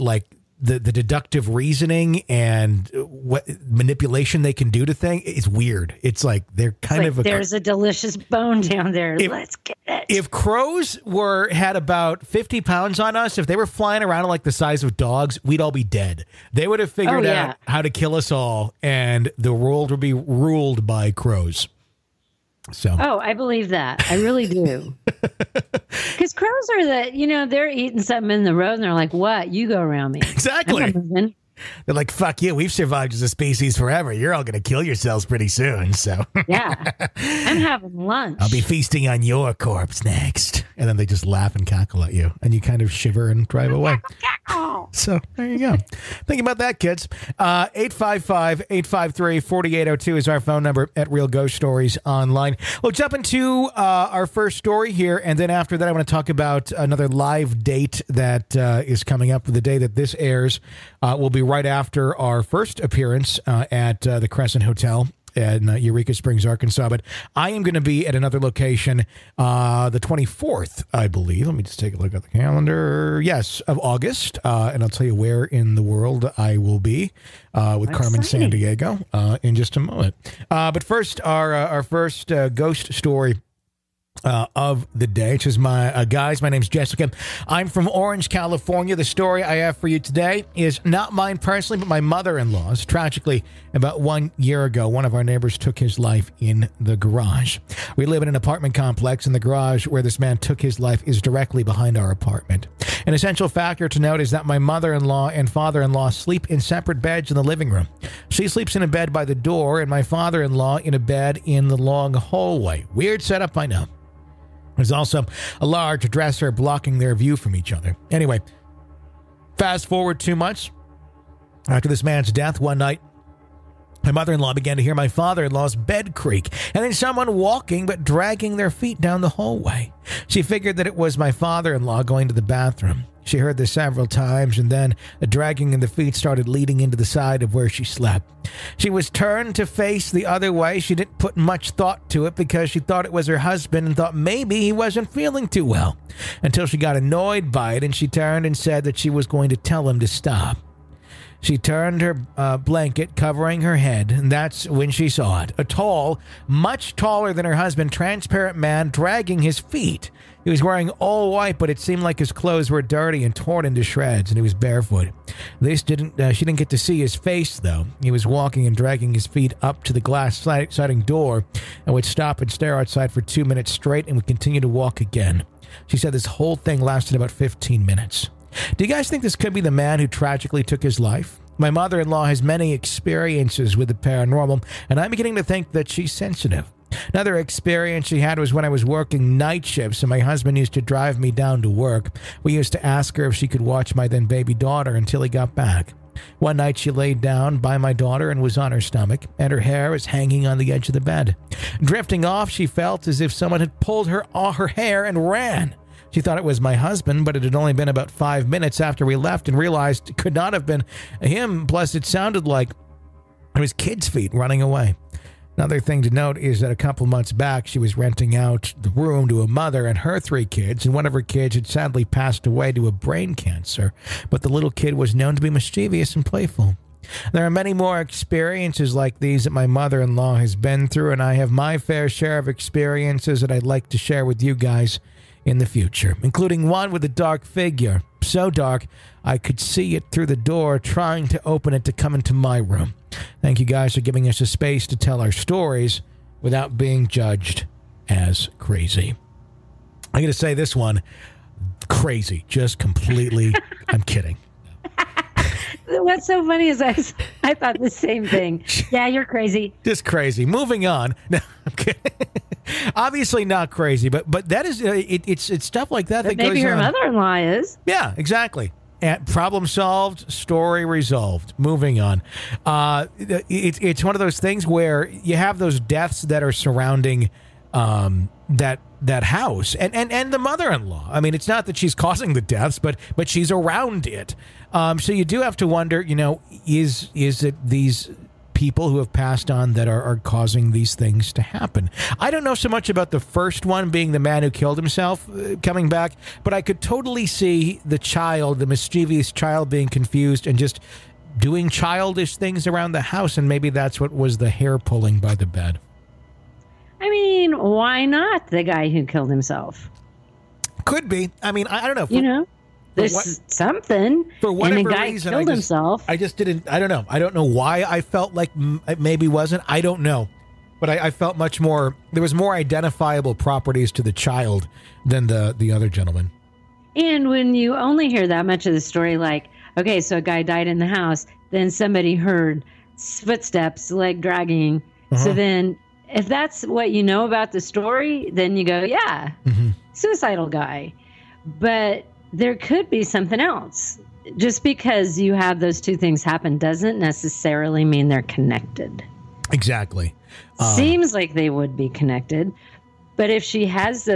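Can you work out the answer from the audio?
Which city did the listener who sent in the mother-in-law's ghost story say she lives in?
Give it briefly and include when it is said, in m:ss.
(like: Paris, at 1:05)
Orange, California, at 1:27.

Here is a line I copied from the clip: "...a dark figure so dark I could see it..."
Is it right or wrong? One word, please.
right.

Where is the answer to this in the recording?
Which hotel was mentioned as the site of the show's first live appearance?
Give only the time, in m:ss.
1:04.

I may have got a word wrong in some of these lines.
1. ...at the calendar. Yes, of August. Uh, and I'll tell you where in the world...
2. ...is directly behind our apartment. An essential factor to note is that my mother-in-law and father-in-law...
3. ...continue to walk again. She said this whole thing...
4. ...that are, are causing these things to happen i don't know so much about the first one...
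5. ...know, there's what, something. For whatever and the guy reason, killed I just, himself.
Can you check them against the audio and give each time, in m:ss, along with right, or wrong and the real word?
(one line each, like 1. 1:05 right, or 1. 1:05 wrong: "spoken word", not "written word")
1. 1:12 right
2. 1:41 right
3. 2:54 right
4. 4:49 right
5. 5:12 right.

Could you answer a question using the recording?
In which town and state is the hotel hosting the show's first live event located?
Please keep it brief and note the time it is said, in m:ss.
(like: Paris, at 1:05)
Eureka Springs, Arkansas, at 1:05.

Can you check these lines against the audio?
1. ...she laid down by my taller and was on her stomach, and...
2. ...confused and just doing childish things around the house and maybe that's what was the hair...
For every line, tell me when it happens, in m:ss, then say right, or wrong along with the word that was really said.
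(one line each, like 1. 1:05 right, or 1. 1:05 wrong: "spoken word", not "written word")
1. 3:16 wrong: "daughter", not "taller"
2. 4:59 right.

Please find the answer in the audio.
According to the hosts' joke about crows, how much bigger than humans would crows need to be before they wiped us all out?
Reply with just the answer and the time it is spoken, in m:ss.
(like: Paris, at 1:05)
50 pounds, at 0:12.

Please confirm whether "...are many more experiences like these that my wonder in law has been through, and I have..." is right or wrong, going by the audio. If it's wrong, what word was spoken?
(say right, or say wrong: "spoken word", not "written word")
wrong: "mother", not "wonder".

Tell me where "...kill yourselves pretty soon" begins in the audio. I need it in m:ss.
0:34.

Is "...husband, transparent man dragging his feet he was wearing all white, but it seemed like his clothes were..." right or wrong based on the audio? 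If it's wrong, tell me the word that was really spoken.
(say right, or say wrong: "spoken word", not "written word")
right.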